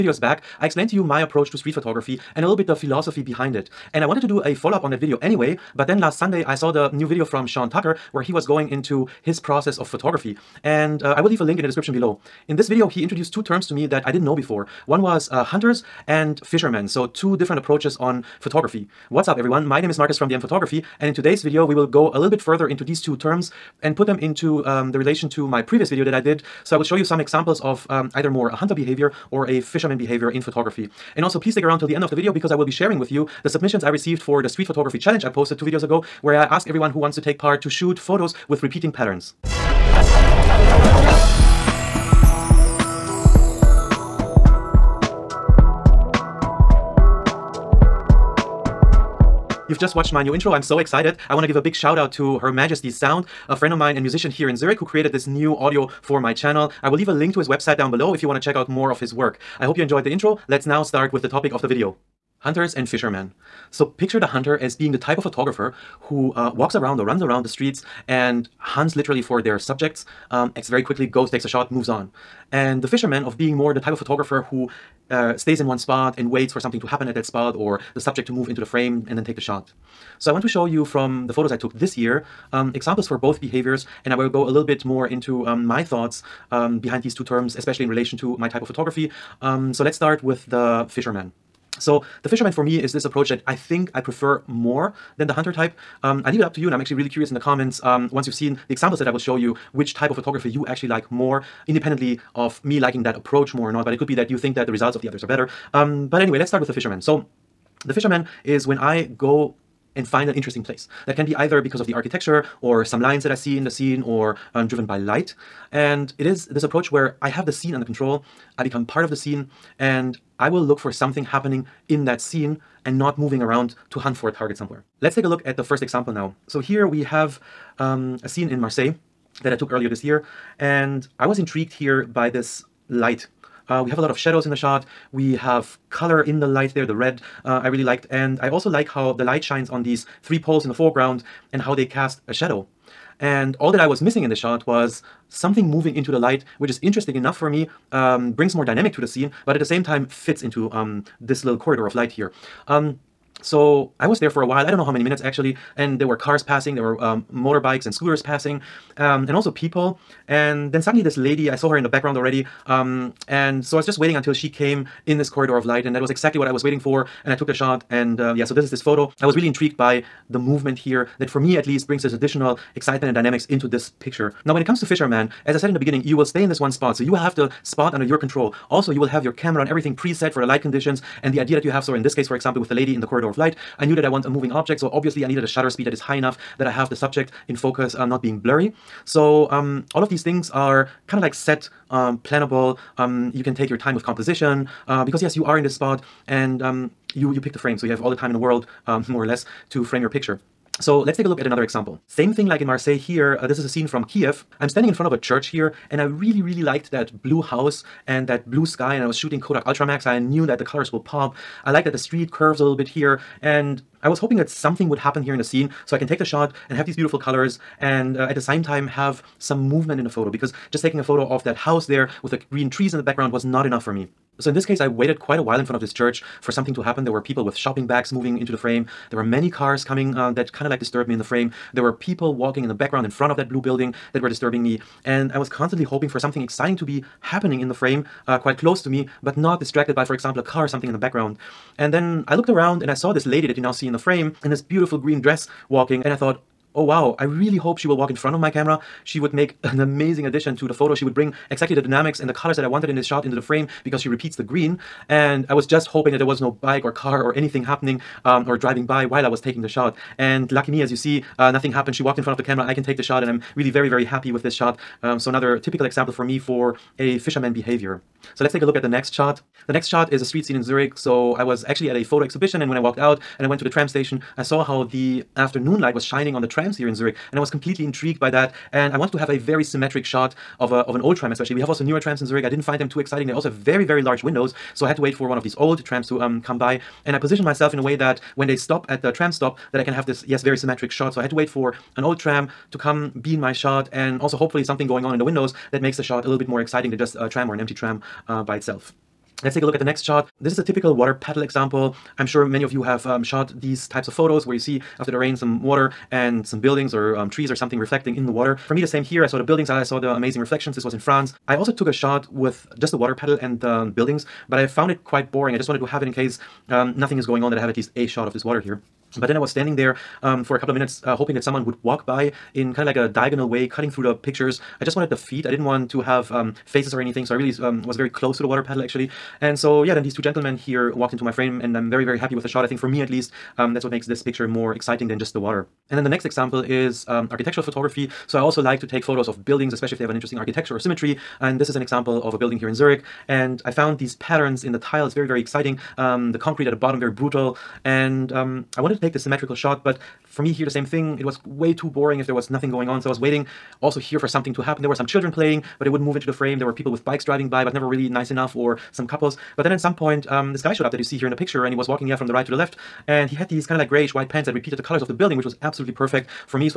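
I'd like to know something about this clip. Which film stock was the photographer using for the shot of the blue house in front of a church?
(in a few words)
Kodak Ultramax.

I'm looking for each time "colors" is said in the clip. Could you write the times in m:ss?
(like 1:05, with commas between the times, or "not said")
2:15, 3:30, 3:37, 4:12, 6:04.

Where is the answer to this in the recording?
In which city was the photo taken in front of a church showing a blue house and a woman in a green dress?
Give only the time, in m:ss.
3:24.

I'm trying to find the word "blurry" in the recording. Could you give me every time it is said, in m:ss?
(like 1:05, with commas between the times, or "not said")
3:08.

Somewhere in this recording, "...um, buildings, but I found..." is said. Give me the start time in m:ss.
5:13.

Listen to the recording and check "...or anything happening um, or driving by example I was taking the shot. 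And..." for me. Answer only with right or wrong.
wrong.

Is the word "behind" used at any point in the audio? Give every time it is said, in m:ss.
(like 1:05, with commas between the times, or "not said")
0:03, 1:26.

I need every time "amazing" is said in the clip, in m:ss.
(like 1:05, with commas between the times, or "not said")
4:09, 5:10.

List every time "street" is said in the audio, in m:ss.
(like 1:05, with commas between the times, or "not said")
0:01, 0:34, 1:07, 3:31, 4:30.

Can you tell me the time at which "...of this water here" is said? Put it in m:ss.
5:18.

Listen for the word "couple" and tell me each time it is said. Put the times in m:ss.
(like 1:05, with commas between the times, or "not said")
5:20, 5:59.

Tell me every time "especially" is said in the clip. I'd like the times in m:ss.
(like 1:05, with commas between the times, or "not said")
1:27, 4:41, 5:39.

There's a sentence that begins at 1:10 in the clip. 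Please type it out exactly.
Um, acts very quickly, goes, takes a shot, moves on.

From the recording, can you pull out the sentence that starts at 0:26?
So I will show you some examples of um, either more a hunter behavior or a fisherman behavior in photography.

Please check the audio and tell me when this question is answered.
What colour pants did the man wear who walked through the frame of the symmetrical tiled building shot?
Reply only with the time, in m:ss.
6:03.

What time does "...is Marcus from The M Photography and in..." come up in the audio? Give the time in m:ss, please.
0:19.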